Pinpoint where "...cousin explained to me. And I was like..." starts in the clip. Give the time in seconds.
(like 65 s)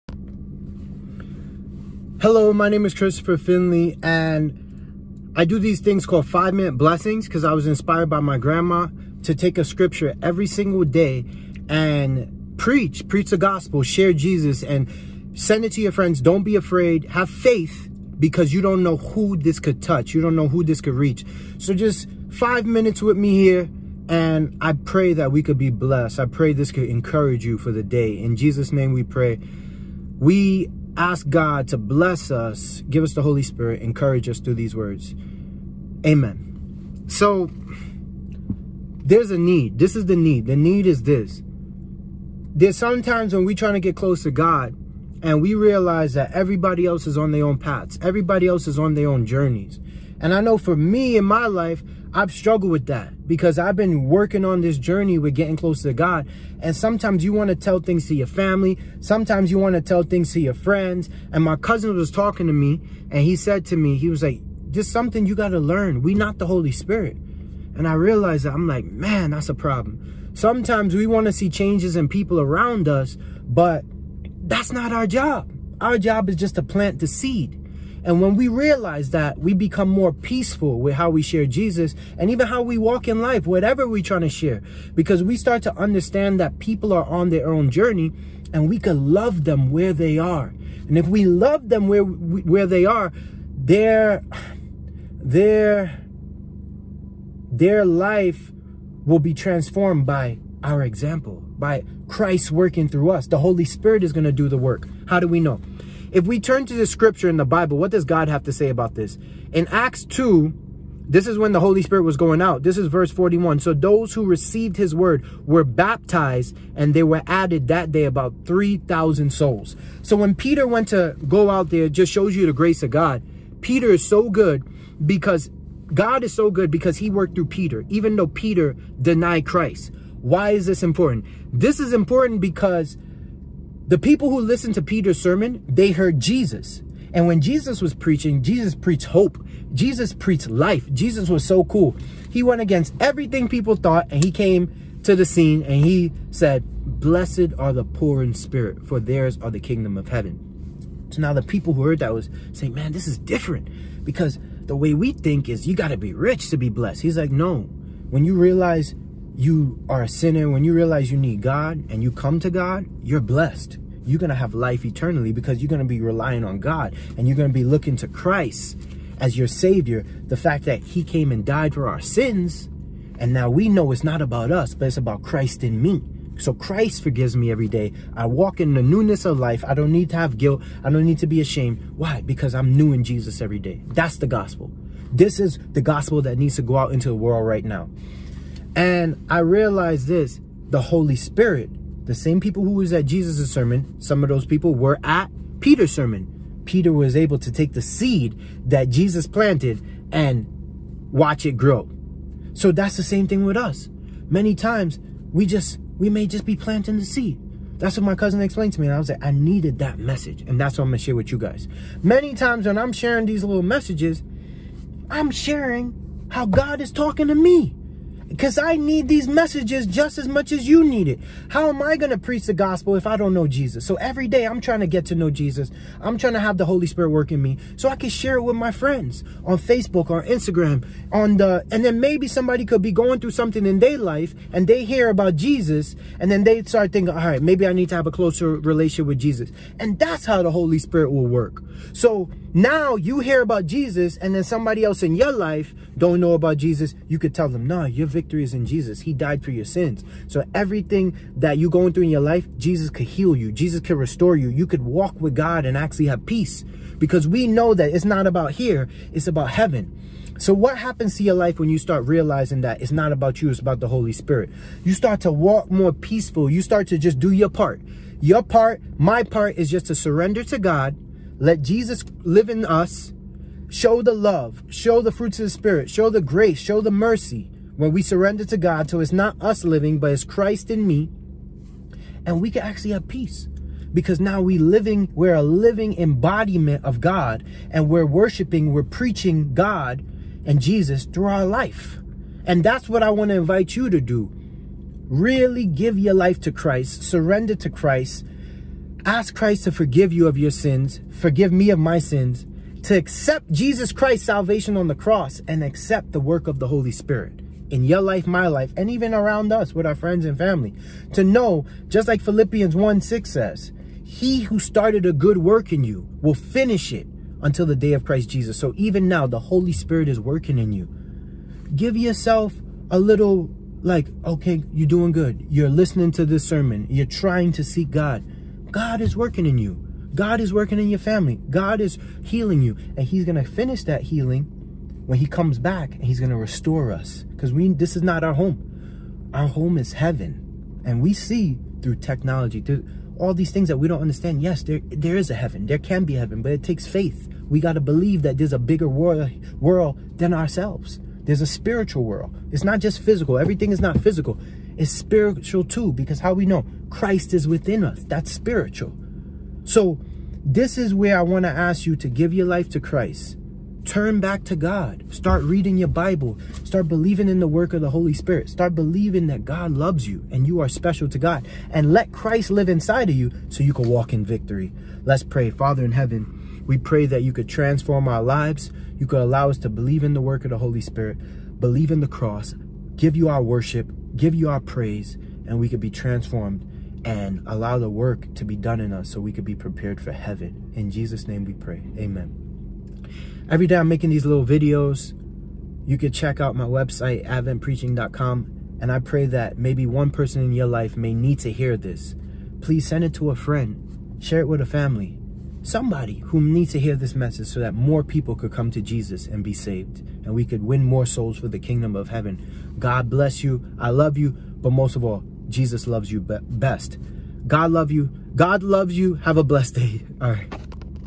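208 s.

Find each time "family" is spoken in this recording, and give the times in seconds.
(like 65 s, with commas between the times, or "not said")
58 s, 310 s, 330 s, 404 s.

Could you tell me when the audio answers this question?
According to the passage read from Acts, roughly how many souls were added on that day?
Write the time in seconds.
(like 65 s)
118 s.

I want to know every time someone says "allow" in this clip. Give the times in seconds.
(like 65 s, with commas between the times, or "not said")
379 s, 387 s.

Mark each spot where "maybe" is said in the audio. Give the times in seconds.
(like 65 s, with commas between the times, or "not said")
231 s, 237 s, 399 s.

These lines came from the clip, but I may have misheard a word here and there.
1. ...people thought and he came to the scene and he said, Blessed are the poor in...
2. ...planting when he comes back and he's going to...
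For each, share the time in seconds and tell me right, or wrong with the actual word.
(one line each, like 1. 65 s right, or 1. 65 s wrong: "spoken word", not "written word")
1. 143 s right
2. 334 s wrong: "healing", not "planting".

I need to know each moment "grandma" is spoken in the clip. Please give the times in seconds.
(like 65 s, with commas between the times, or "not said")
8 s.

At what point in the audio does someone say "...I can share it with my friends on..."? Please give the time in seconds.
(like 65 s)
227 s.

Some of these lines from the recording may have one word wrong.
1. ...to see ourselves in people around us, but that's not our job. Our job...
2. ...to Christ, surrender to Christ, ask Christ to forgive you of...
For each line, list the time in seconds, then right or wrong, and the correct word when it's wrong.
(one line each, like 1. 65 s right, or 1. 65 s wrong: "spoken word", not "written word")
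1. 71 s wrong: "changes", not "ourselves"
2. 296 s right.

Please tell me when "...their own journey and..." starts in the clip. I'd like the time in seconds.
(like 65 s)
87 s.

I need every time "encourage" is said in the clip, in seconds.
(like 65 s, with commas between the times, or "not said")
26 s, 33 s.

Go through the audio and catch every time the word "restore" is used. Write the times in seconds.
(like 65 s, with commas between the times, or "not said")
253 s, 336 s.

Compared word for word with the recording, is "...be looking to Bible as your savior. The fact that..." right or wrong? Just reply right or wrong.
wrong.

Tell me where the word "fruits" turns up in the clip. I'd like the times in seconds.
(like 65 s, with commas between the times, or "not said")
275 s.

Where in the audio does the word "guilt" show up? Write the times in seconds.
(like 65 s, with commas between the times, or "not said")
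180 s.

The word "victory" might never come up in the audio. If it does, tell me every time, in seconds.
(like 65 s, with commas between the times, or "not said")
248 s, 374 s.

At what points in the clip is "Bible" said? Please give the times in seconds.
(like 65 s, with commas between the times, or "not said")
107 s, 365 s.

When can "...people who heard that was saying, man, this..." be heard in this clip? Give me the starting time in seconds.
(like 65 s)
151 s.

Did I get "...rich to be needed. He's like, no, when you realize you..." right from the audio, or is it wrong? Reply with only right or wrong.
wrong.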